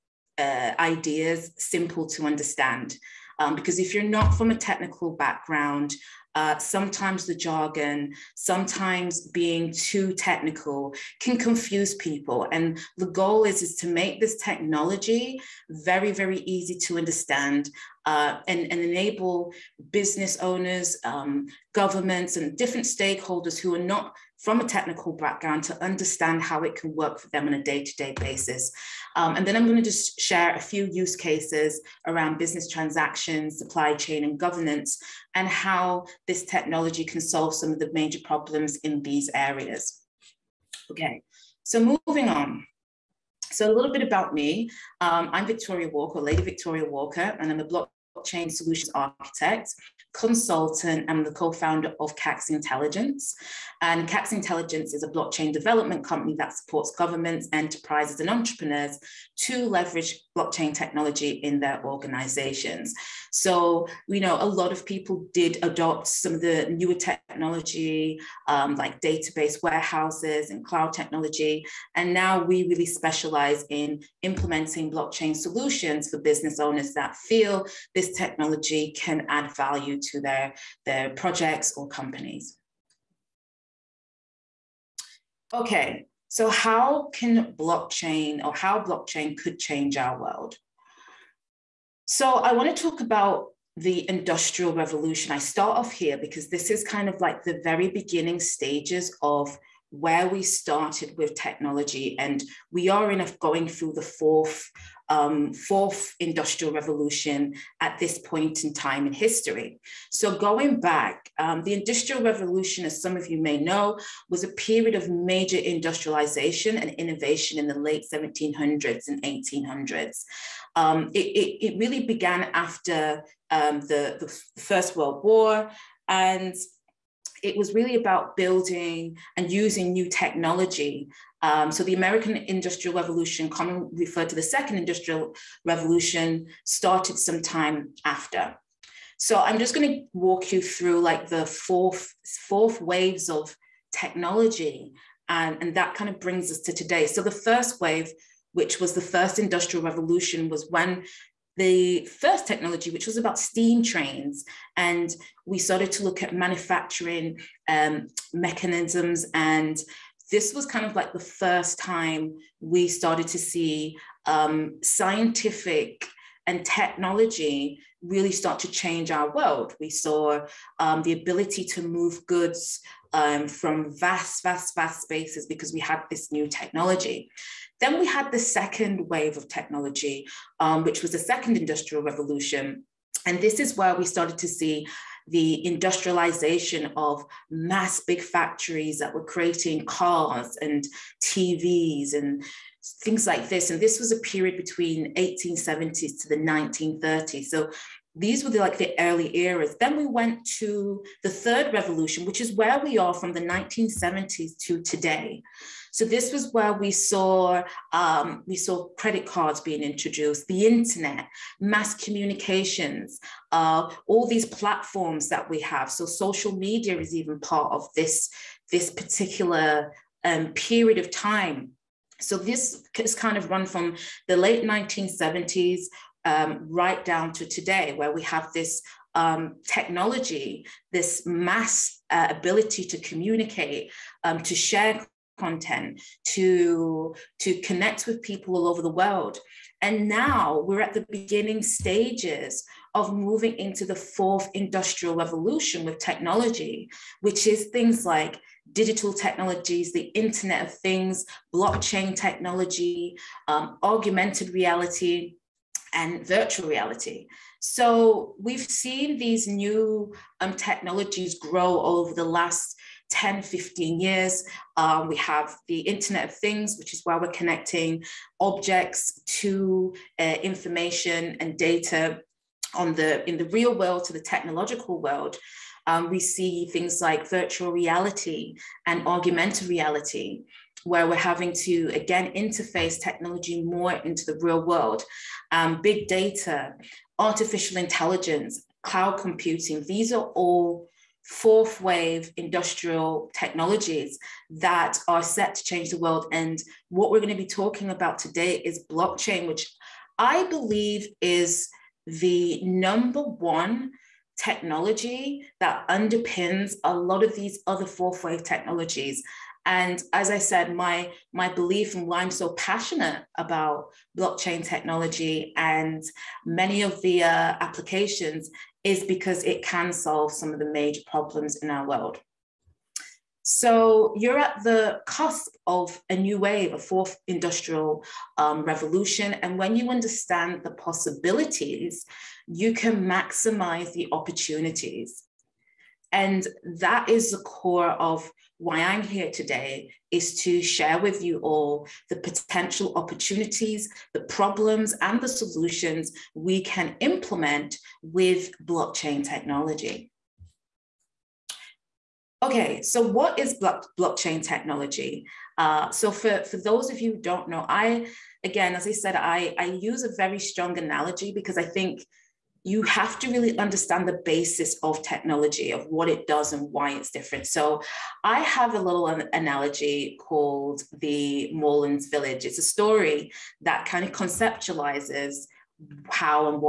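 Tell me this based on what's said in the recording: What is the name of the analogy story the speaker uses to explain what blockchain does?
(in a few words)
the Moorlands village.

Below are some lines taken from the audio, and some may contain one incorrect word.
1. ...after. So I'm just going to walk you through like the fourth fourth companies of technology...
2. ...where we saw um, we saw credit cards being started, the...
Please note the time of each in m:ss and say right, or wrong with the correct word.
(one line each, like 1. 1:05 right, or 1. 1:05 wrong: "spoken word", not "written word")
1. 2:18 wrong: "waves", not "companies"
2. 3:26 wrong: "introduced", not "started".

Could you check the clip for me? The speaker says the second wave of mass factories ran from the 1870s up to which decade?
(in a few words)
1930s.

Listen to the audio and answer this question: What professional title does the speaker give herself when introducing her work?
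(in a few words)
blockchain solutions architect consultant.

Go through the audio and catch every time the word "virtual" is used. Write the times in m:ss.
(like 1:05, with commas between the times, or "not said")
4:16, 4:37.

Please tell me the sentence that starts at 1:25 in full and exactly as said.
Okay, so how can blockchain or how blockchain could change our world?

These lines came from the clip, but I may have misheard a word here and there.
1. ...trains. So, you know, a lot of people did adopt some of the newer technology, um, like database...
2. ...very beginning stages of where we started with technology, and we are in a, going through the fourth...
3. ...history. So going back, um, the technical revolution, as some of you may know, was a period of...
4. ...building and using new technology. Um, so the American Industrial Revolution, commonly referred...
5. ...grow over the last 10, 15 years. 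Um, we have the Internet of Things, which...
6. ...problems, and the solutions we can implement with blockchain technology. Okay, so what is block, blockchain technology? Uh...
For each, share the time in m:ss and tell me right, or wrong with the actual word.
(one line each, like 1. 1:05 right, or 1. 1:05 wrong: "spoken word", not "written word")
1. 1:01 wrong: "organizations", not "trains"
2. 1:37 right
3. 1:49 wrong: "industrial", not "technical"
4. 2:08 right
5. 4:21 right
6. 5:44 right.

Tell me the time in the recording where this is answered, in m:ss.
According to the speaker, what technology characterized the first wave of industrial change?
2:33.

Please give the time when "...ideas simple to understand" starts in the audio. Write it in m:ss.
0:00.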